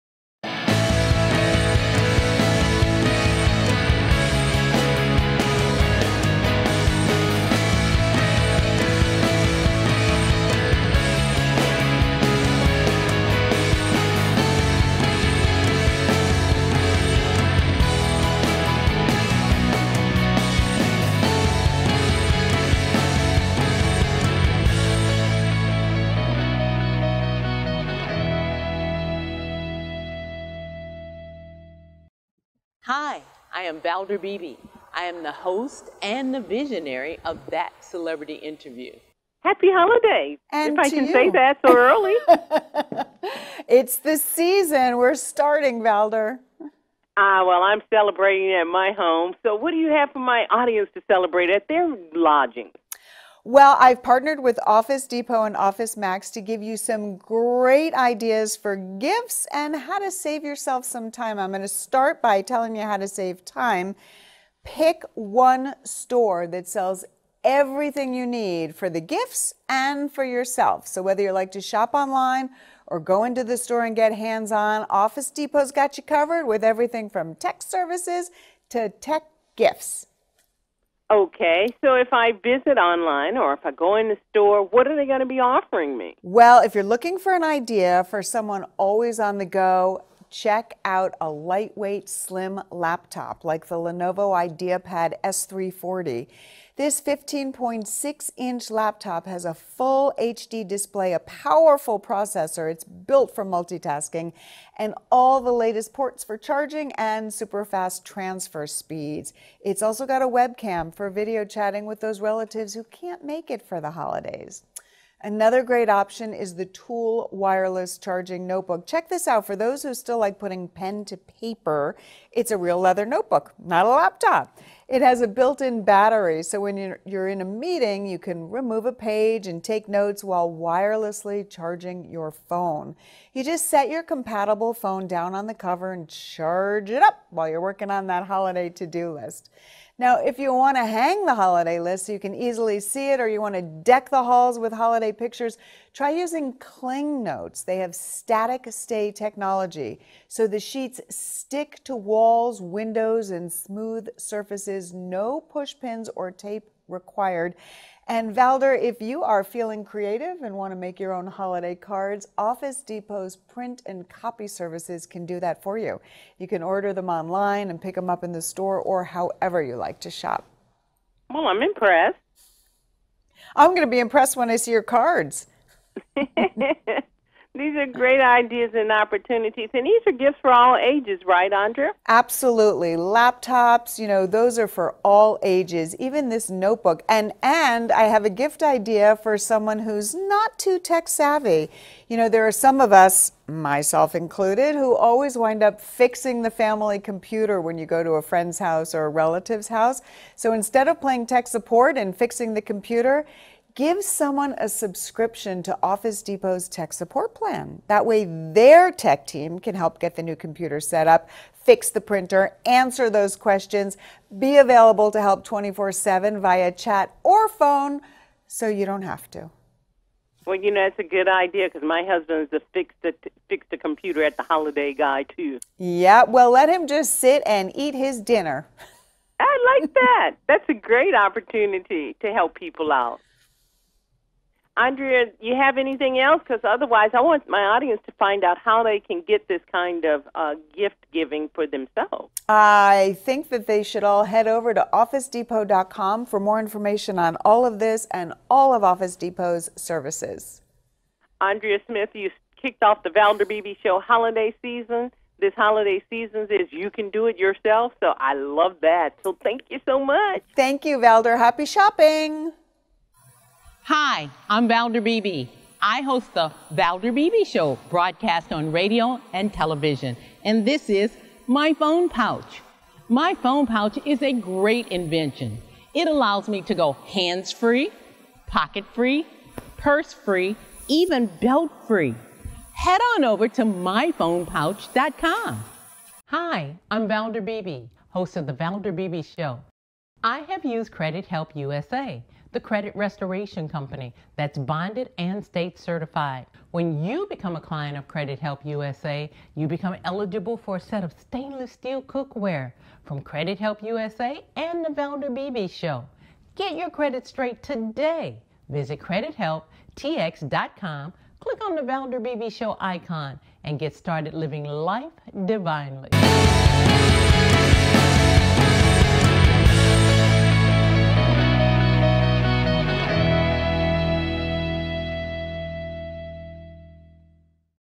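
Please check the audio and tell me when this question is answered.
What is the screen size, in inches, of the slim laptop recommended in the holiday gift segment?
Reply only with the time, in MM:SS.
01:37.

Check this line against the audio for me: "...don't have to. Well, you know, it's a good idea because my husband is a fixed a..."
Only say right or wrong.
right.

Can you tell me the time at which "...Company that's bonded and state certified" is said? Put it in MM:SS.
04:53.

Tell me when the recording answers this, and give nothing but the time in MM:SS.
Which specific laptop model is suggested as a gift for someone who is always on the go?
01:33.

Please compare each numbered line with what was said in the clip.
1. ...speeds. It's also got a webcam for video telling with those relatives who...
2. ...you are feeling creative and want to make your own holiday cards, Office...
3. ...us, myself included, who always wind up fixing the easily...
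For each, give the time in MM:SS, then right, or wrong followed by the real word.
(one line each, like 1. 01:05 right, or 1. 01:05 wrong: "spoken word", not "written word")
1. 01:48 wrong: "chatting", not "telling"
2. 02:39 right
3. 03:12 wrong: "family", not "easily".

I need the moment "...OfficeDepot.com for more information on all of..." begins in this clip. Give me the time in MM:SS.
04:04.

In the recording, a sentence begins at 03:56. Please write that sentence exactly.
Because otherwise, I want my audience to find out how they can get this kind of uh, gift giving for themselves.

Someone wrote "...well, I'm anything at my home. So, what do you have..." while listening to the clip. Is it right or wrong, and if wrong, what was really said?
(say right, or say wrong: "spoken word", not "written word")
wrong: "celebrating", not "anything".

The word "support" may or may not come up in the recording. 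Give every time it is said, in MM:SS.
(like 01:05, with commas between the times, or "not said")
03:21, 03:26.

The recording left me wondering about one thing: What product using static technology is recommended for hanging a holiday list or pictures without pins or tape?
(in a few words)
Cling Notes.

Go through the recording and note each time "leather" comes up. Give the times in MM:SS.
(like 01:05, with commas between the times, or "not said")
02:02.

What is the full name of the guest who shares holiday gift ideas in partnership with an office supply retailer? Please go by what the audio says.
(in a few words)
Andrea Smith.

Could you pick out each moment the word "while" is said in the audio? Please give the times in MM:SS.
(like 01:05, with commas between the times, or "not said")
02:10, 02:17.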